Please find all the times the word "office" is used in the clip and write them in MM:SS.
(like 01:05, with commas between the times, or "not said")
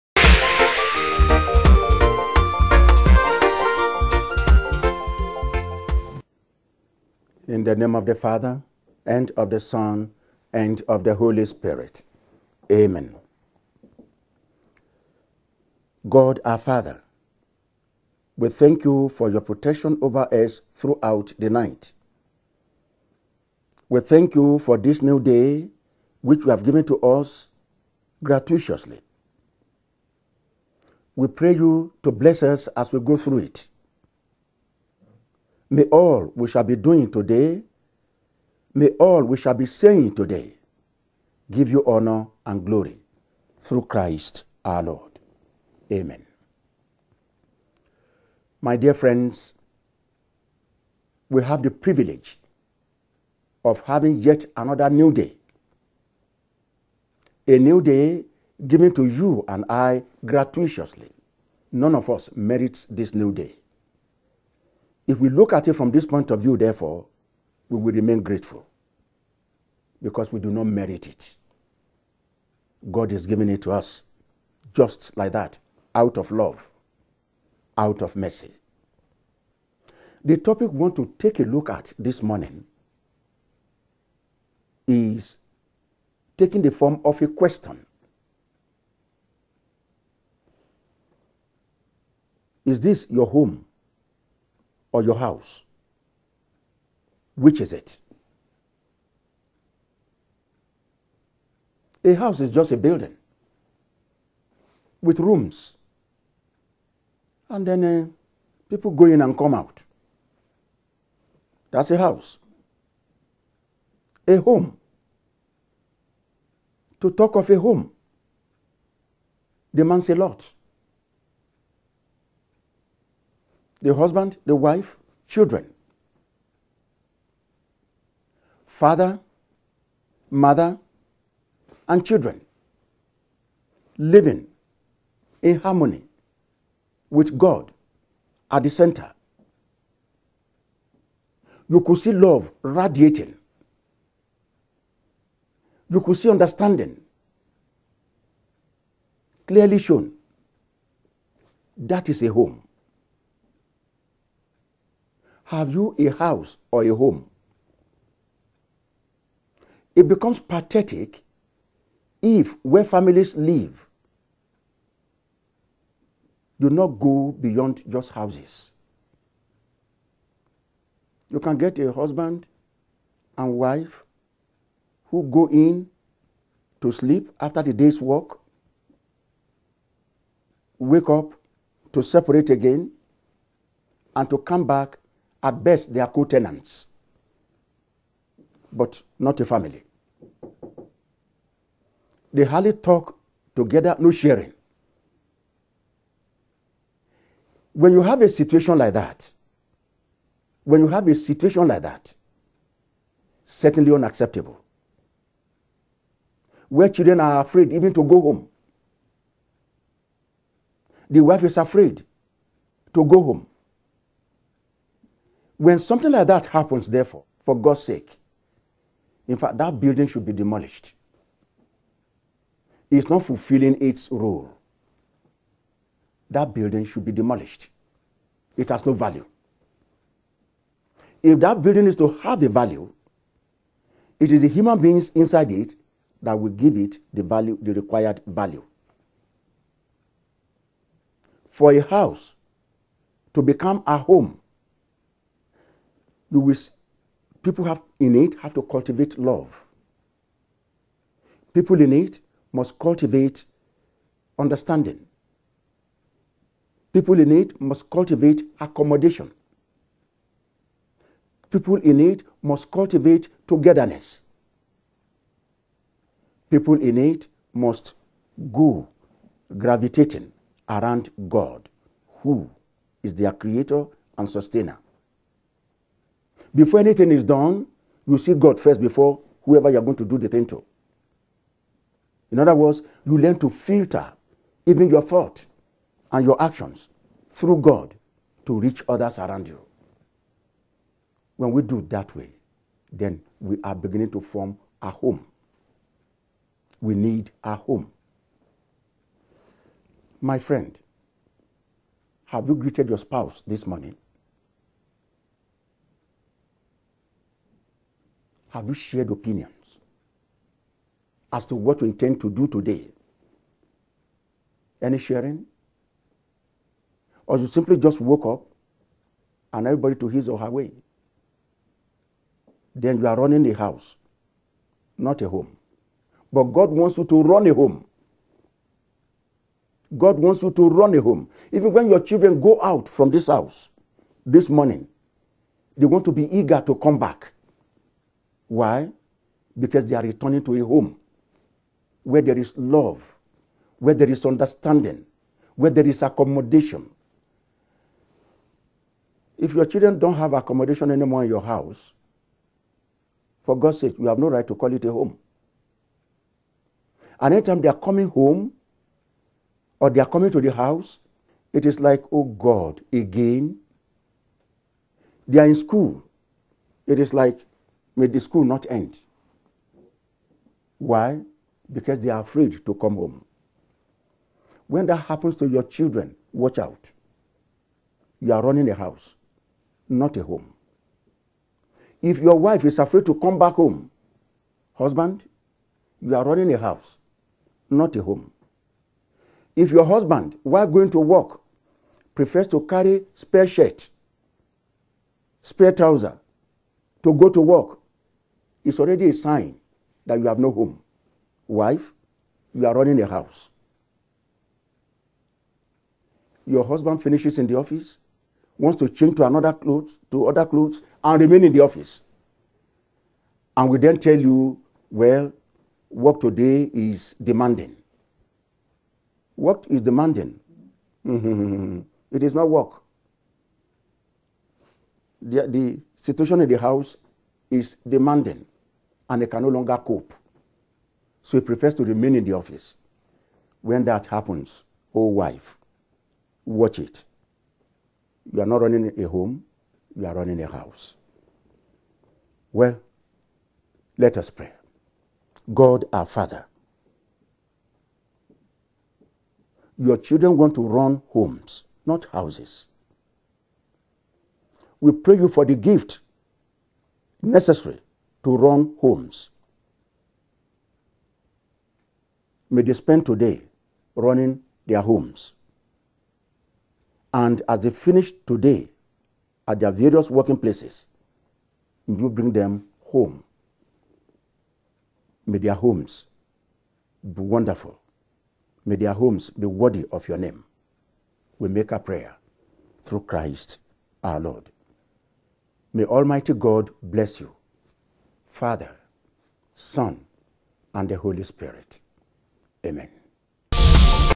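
06:47, 06:51, 07:12.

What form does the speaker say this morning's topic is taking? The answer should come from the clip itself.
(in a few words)
A question.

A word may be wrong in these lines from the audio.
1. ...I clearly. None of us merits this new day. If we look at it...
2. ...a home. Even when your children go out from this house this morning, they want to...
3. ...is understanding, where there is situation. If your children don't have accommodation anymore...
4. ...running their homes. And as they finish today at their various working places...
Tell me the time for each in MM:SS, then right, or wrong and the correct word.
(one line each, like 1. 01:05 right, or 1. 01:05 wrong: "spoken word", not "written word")
1. 00:59 wrong: "gratuitously", not "clearly"
2. 05:30 right
3. 05:44 wrong: "accommodation", not "situation"
4. 07:43 right.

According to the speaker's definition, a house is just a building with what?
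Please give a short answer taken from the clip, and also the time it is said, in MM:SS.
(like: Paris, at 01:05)
Rooms, at 01:45.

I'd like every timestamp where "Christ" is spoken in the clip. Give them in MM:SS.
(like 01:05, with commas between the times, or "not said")
00:43, 08:03.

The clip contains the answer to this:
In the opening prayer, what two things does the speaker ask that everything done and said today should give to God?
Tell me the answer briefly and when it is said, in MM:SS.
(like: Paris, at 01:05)
Honor and glory, at 00:41.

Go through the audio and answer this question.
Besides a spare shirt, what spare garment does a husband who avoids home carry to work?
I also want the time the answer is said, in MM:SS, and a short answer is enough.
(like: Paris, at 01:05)
Spare trouser, at 06:35.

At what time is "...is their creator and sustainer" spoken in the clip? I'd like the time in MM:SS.
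04:33.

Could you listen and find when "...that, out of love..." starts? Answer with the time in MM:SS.
01:15.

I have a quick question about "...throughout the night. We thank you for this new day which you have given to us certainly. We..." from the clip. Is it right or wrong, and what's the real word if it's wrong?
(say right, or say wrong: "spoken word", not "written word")
wrong: "gratuitously", not "certainly".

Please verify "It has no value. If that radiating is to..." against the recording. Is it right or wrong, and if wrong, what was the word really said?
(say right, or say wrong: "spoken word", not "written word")
wrong: "building", not "radiating".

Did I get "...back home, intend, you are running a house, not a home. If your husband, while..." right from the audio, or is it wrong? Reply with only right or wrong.
wrong.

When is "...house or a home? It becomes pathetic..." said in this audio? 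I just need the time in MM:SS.
02:36.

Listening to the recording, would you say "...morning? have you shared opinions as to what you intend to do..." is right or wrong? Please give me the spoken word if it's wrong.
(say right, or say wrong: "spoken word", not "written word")
right.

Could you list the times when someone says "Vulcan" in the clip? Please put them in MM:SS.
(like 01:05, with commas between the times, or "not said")
not said.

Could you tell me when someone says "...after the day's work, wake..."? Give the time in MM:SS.
02:57.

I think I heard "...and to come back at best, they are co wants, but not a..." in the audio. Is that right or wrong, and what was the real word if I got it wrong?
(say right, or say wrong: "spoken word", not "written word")
wrong: "tenants", not "wants".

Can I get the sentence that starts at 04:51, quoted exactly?
When we do that way, then we are beginning to form a home.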